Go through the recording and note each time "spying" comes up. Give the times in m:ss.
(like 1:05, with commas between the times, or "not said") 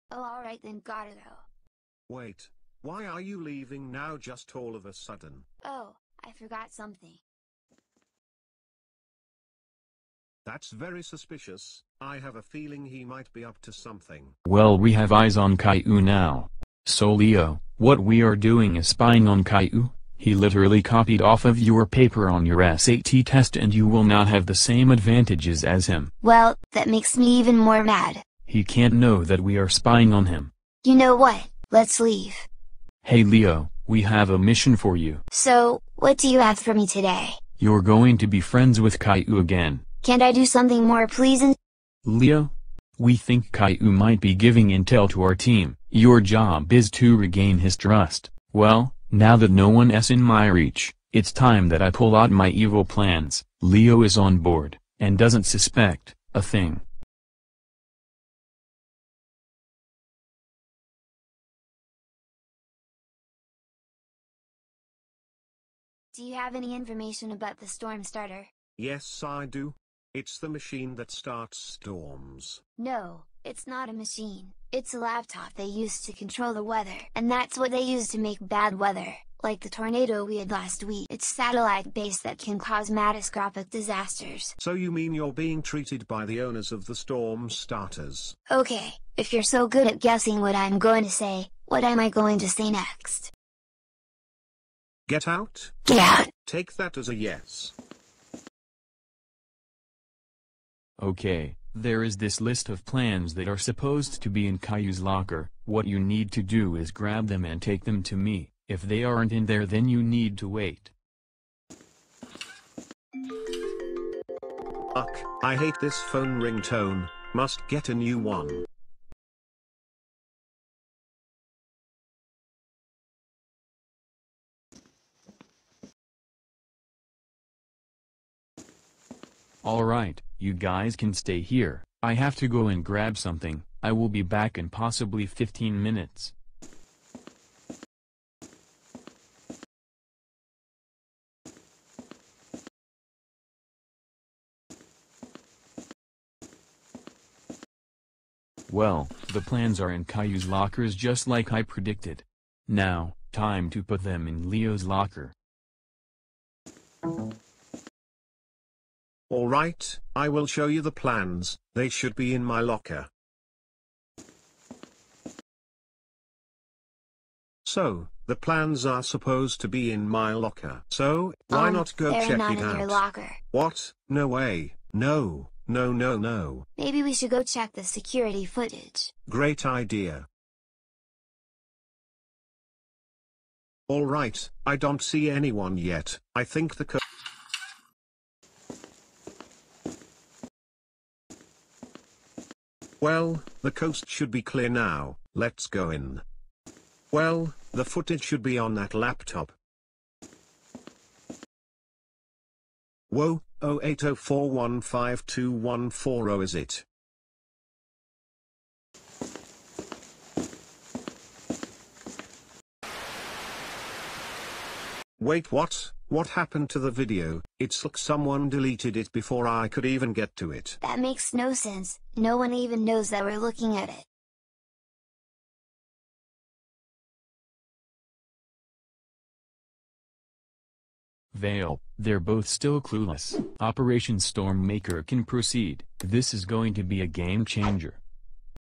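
0:18, 0:29.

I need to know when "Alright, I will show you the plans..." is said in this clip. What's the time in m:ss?
2:39.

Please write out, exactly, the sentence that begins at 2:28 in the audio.
Well, the plans are in Caillou's lockers just like I predicted.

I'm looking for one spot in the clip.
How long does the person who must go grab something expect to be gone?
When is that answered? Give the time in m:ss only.
2:15.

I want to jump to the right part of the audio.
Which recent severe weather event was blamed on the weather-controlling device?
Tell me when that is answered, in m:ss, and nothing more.
1:19.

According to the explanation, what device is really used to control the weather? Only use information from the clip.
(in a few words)
A laptop.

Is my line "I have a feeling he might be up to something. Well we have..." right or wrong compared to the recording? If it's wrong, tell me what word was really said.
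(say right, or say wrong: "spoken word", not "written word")
right.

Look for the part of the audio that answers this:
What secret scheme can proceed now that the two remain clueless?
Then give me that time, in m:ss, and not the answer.
3:53.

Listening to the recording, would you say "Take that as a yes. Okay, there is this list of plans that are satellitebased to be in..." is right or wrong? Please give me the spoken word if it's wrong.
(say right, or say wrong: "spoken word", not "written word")
wrong: "supposed", not "satellitebased".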